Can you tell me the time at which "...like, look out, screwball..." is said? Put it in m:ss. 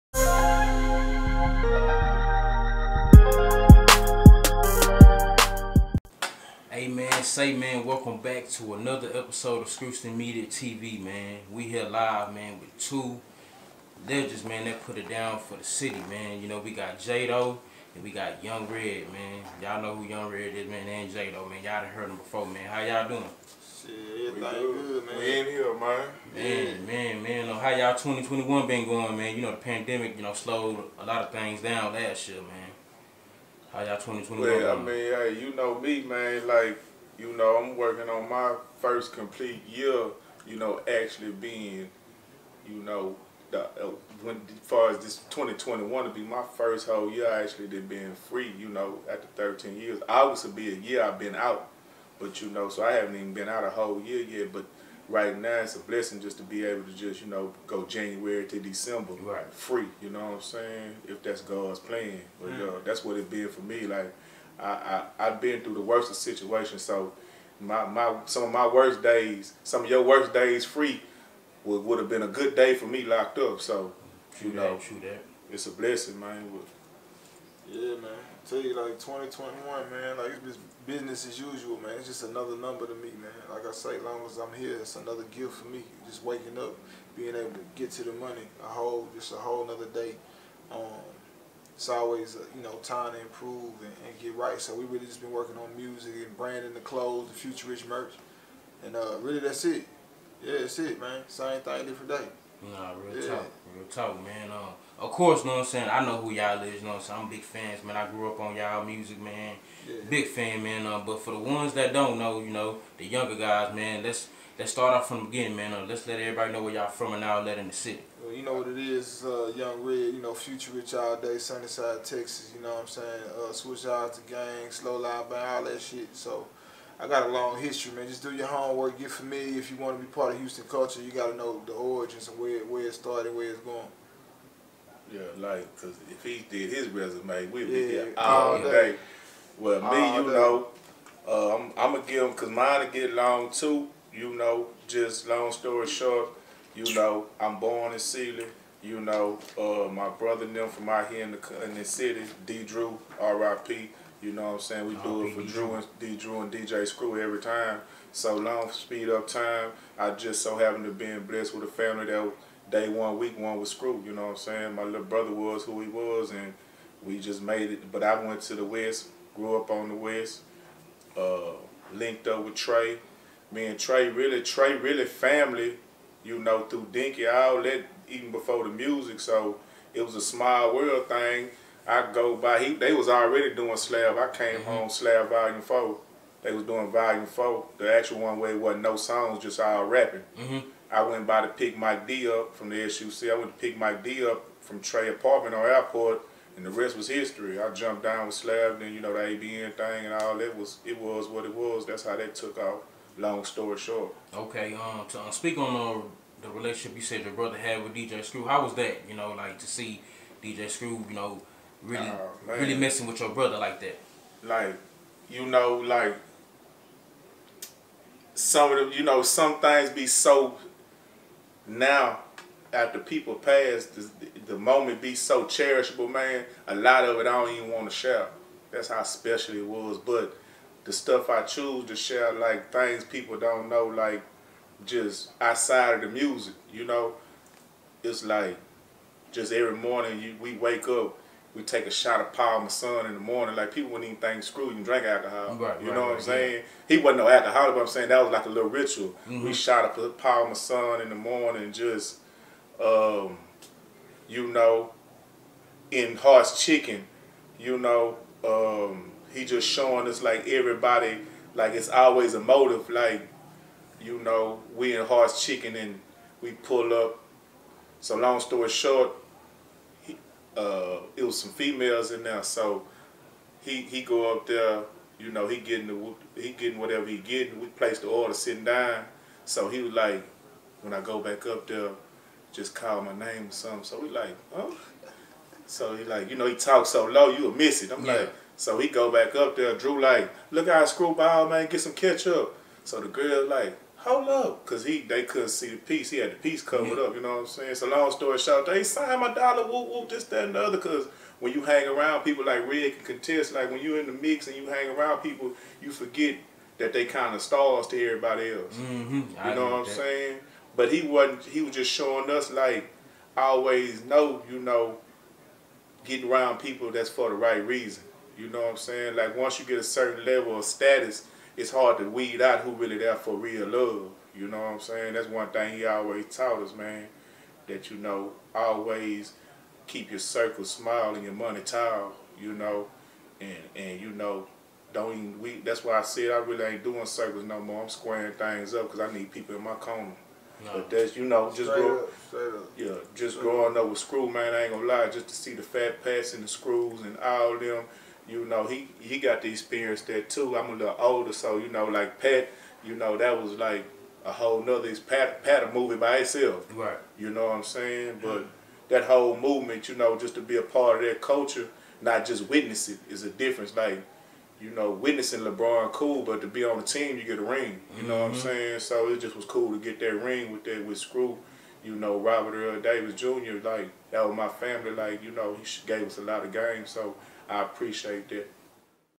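4:50.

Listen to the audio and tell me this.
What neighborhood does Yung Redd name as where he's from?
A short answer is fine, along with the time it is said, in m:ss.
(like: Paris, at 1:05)
Sunnyside, at 2:01.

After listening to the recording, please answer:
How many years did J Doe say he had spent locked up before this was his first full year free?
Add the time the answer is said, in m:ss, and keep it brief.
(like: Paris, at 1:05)
13, at 0:49.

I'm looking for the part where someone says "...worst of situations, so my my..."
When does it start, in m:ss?
1:05.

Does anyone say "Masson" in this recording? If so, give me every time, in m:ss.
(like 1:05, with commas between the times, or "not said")
4:02, 4:10.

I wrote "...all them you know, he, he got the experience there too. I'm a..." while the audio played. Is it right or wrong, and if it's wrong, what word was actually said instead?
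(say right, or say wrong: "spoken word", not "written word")
right.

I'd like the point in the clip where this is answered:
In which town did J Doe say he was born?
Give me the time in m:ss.
2:27.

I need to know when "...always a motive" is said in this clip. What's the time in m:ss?
4:21.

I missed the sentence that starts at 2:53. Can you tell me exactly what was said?
Me and Trae really, Trae really family, you know, through Dinky, all that, even before the music.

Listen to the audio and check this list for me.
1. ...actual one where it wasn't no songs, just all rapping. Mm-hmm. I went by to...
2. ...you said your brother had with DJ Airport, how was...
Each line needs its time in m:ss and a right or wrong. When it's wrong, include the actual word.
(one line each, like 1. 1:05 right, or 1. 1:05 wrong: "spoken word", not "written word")
1. 3:07 right
2. 3:26 wrong: "Screw", not "Airport".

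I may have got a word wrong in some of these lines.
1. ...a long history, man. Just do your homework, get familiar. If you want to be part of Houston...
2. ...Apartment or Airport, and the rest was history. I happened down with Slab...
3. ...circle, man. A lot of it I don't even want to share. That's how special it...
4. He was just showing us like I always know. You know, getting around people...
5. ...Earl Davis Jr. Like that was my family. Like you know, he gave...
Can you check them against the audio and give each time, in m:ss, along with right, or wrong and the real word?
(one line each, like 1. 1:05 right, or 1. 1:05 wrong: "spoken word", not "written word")
1. 2:07 right
2. 3:15 wrong: "jumped", not "happened"
3. 3:45 wrong: "cherishable", not "circle"
4. 5:11 right
5. 6:12 right.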